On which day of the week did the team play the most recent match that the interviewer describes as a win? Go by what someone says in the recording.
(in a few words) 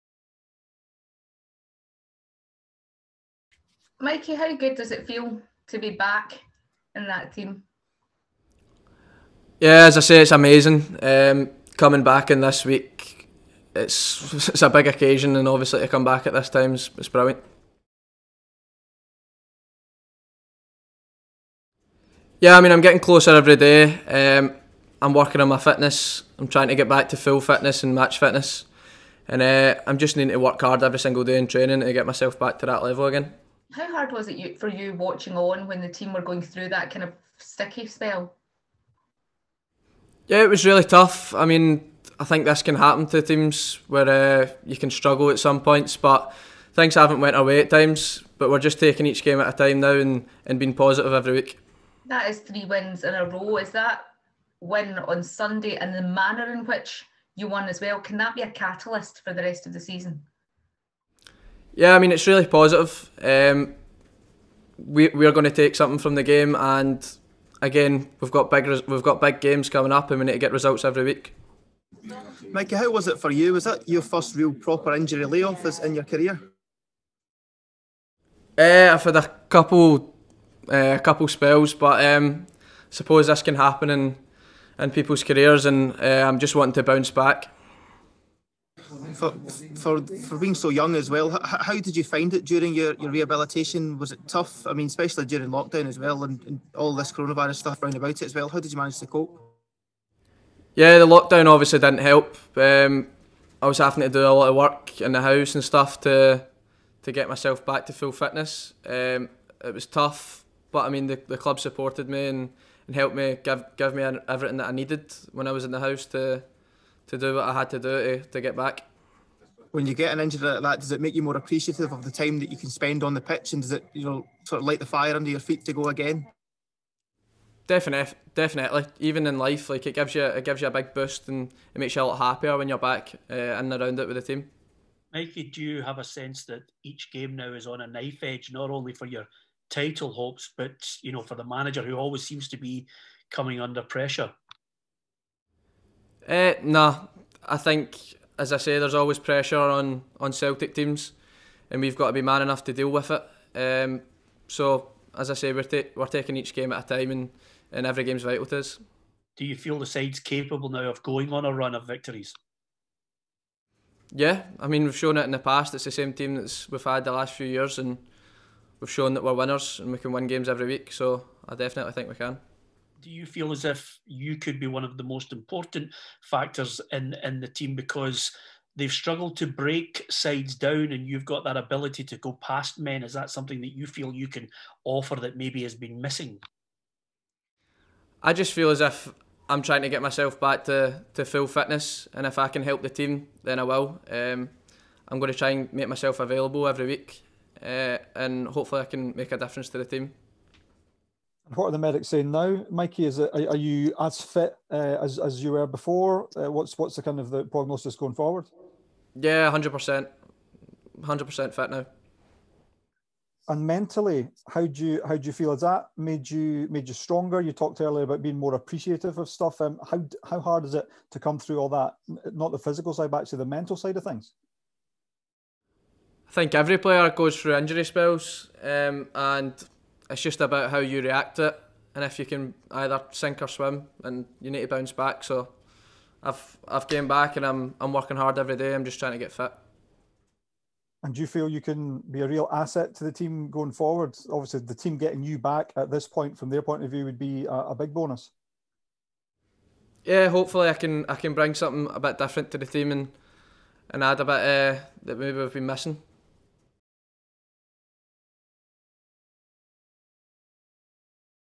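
Sunday.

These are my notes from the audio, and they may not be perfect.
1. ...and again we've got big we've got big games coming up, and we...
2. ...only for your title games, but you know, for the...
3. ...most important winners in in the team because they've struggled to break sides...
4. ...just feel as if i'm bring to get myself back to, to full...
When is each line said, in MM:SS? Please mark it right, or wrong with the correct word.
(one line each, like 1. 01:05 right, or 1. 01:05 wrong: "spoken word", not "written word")
1. 01:06 right
2. 02:18 wrong: "hopes", not "games"
3. 02:55 wrong: "factors", not "winners"
4. 03:08 wrong: "trying", not "bring".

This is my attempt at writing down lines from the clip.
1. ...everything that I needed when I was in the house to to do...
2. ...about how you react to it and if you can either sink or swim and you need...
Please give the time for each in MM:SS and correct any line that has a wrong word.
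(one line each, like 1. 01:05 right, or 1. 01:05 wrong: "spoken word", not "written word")
1. 01:54 right
2. 03:50 right.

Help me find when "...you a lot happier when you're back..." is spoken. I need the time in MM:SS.
02:11.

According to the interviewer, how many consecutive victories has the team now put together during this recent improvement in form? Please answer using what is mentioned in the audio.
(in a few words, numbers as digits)
3.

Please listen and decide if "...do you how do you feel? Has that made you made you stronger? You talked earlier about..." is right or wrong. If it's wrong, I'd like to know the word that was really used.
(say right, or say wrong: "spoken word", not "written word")
right.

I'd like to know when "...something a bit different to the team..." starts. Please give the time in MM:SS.
04:11.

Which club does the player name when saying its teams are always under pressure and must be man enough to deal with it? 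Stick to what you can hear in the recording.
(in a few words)
Celtic.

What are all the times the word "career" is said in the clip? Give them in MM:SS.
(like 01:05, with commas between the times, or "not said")
01:16, 01:25.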